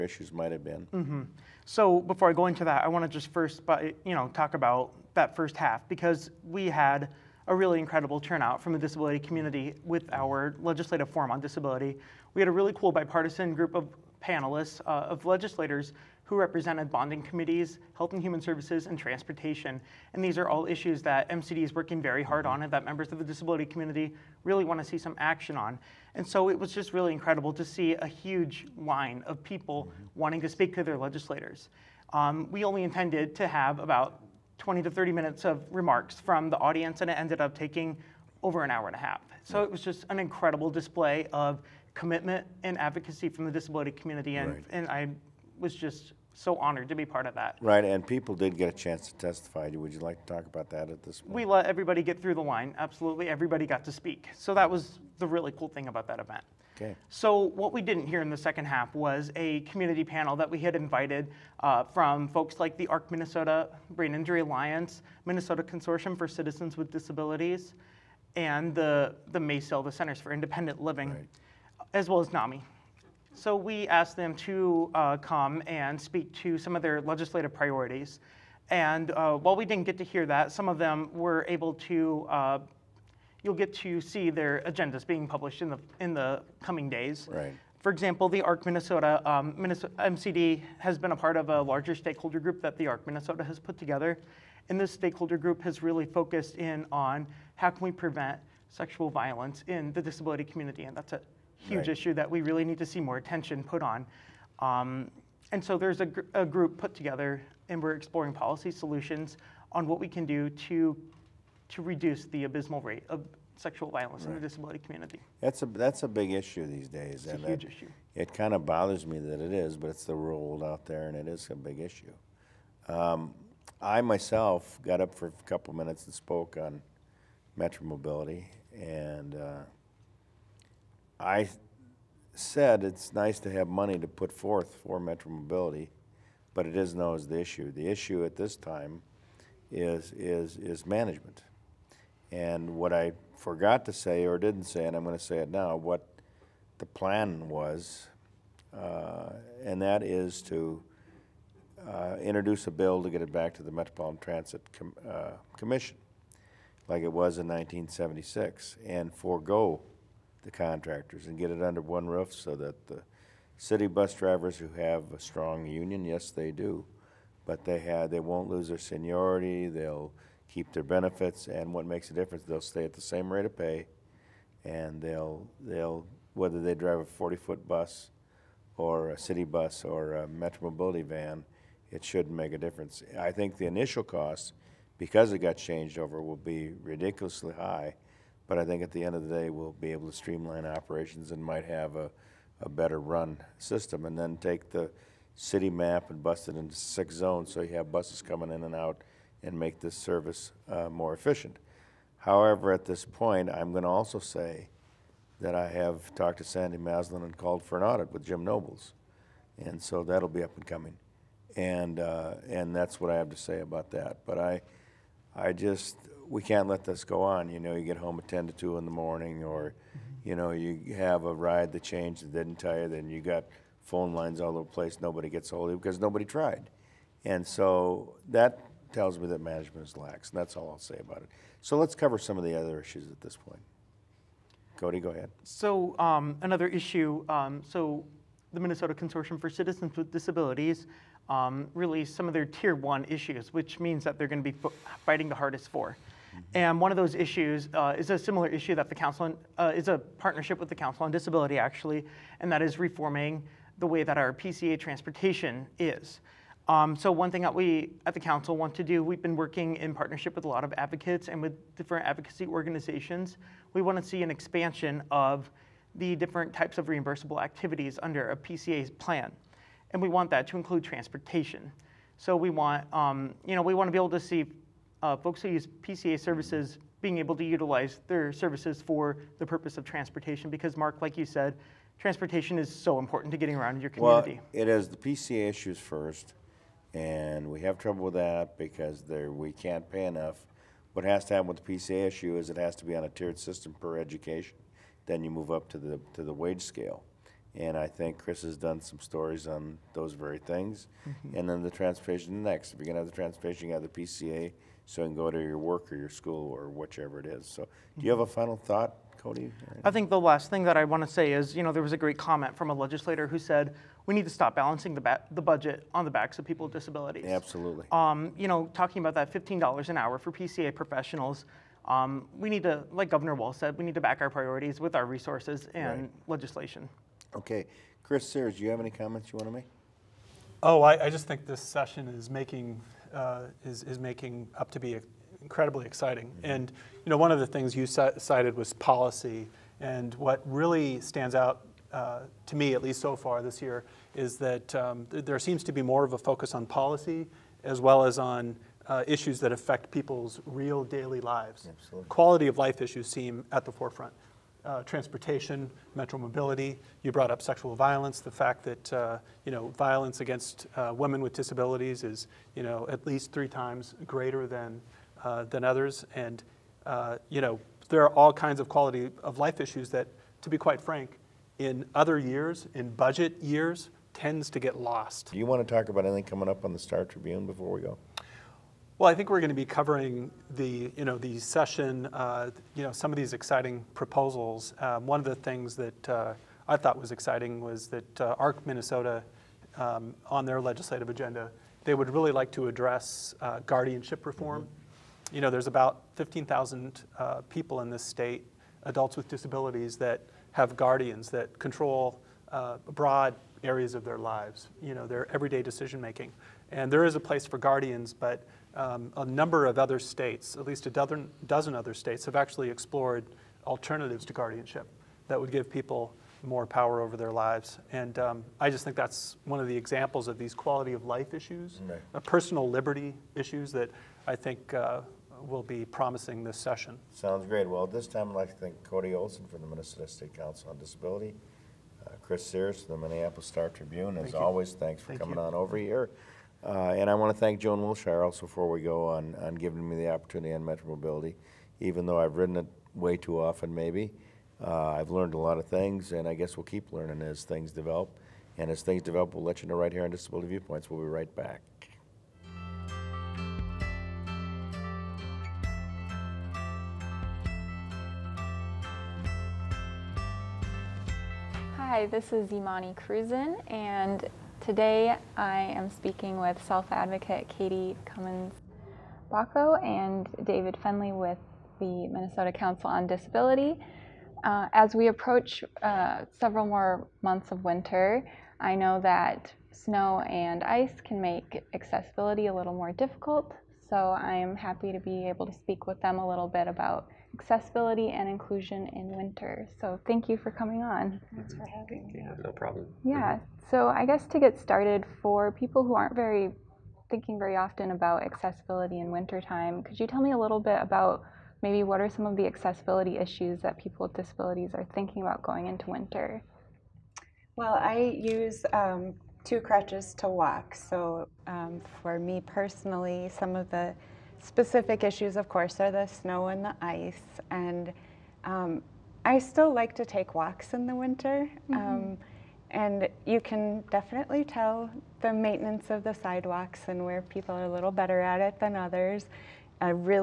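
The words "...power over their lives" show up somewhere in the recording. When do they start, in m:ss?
6:56.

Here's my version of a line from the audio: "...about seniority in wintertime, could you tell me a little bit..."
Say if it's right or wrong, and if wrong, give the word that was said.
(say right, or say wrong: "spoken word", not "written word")
wrong: "accessibility", not "seniority".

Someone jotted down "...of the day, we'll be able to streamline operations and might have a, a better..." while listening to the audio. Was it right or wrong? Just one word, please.
right.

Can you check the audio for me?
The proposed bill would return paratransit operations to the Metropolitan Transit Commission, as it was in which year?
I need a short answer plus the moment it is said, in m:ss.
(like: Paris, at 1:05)
1976, at 2:37.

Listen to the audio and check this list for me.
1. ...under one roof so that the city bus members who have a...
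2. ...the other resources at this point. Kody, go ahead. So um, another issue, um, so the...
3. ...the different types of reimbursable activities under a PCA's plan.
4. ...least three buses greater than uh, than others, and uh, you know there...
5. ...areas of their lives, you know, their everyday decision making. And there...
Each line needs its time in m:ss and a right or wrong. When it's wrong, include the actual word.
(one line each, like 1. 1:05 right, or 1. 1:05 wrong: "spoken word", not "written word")
1. 2:41 wrong: "drivers", not "members"
2. 3:52 wrong: "issues", not "resources"
3. 4:25 right
4. 6:03 wrong: "times", not "buses"
5. 6:43 right.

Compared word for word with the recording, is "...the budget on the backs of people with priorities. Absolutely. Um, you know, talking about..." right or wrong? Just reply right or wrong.
wrong.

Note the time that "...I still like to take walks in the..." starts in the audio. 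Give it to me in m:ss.
8:39.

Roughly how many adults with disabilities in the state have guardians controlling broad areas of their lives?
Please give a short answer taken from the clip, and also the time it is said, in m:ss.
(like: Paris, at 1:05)
15,000, at 6:36.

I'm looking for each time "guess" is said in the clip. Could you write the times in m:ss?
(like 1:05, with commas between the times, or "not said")
7:26, 8:14.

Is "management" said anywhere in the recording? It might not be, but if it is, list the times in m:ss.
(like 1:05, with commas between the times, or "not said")
2:20, 3:49.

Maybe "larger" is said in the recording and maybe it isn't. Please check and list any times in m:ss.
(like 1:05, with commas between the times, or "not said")
1:31.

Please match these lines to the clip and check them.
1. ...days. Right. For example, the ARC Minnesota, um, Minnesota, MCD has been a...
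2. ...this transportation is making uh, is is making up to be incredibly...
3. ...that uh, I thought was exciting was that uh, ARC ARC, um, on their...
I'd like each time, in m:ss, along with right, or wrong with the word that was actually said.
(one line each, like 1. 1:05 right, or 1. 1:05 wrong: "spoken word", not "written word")
1. 1:26 right
2. 5:31 wrong: "session", not "transportation"
3. 6:25 wrong: "Minnesota", not "ARC".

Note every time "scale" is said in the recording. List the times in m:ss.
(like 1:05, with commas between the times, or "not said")
4:56.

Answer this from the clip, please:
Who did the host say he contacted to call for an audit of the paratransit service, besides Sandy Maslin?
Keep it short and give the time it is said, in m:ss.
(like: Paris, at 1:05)
Jim Nobles, at 3:28.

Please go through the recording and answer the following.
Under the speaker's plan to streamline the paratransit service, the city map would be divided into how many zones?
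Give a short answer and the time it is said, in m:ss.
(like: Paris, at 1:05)
6, at 3:16.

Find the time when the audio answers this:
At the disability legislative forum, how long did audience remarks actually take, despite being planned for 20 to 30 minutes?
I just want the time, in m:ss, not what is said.
0:38.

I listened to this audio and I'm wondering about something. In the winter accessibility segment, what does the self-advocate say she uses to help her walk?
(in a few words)
Two crutches.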